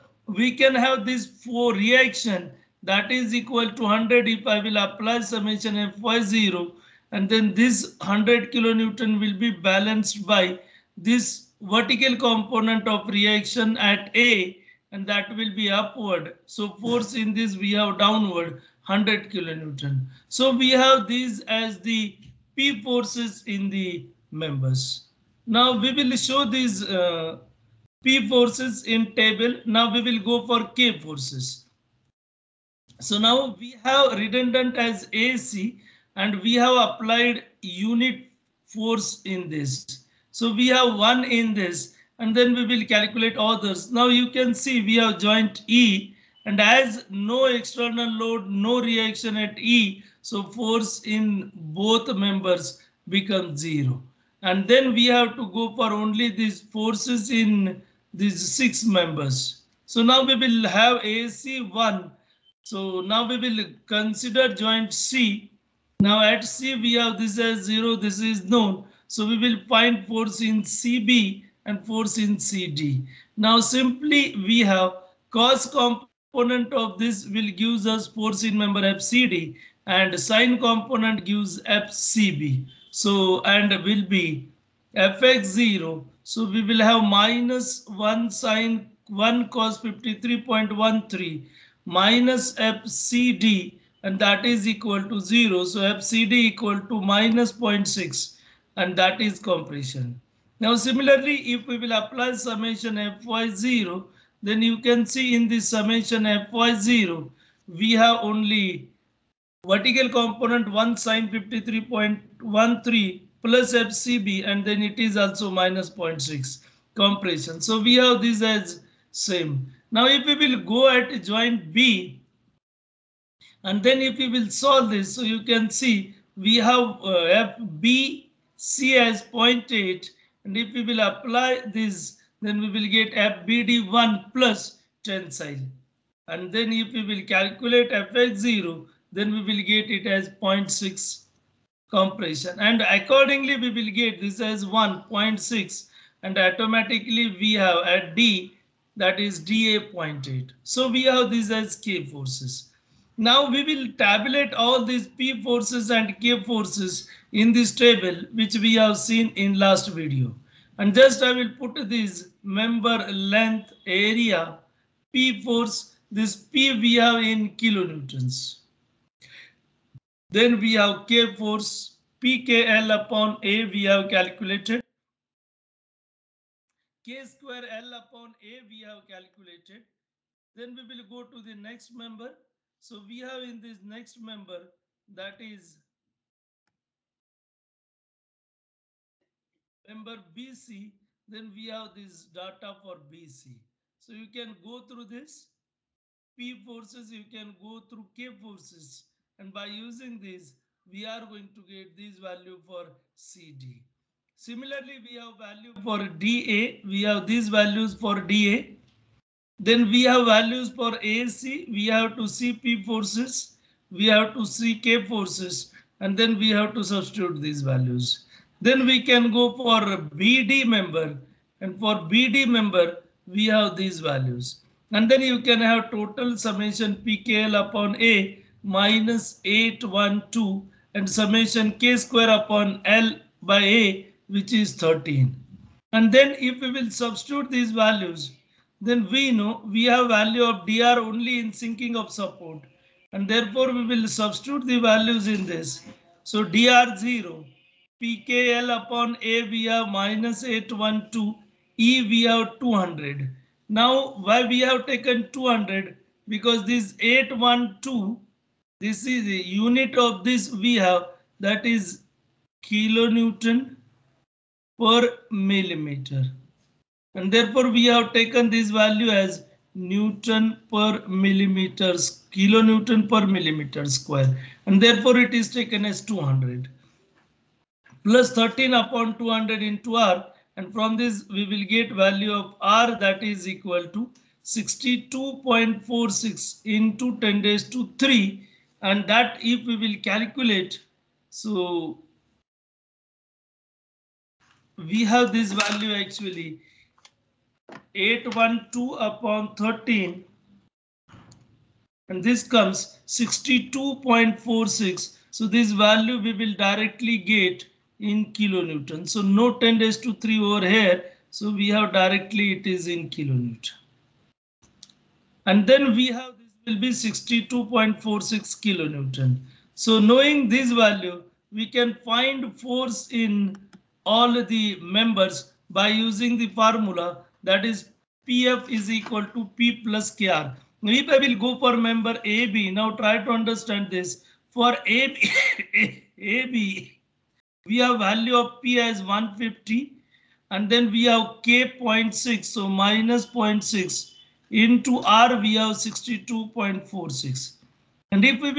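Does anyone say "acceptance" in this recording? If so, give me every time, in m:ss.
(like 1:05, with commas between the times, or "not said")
not said.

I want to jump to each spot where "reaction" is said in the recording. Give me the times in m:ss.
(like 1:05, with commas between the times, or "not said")
0:01, 0:13, 0:48.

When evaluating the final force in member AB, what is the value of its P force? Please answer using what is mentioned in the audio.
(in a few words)
150.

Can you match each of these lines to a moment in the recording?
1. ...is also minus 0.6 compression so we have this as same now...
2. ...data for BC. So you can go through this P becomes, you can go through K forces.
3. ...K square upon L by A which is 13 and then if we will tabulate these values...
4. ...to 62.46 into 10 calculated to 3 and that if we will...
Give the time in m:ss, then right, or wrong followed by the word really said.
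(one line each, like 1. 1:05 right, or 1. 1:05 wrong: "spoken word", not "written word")
1. 1:54 right
2. 3:12 wrong: "forces", not "becomes"
3. 3:51 wrong: "substitute", not "tabulate"
4. 4:43 wrong: "raised", not "calculated".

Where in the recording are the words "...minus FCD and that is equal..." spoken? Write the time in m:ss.
1:31.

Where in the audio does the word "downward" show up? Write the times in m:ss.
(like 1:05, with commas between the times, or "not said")
0:17.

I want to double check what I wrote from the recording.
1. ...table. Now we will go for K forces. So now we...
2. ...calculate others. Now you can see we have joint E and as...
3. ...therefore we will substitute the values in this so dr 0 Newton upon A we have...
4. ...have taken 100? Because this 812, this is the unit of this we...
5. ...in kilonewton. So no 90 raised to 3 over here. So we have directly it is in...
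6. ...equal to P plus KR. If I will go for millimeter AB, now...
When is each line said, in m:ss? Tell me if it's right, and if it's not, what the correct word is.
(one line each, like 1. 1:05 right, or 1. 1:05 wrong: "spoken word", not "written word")
1. 0:29 right
2. 0:42 right
3. 4:03 wrong: "PKL", not "Newton"
4. 4:14 wrong: "200", not "100"
5. 5:08 wrong: "10", not "90"
6. 5:28 wrong: "member", not "millimeter".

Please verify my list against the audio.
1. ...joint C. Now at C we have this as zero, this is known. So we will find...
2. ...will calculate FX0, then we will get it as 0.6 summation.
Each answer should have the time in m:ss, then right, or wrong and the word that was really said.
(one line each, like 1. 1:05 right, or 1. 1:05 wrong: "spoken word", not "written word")
1. 1:04 right
2. 2:17 wrong: "compression", not "summation".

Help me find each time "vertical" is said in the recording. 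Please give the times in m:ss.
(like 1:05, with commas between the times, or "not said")
0:11, 1:49.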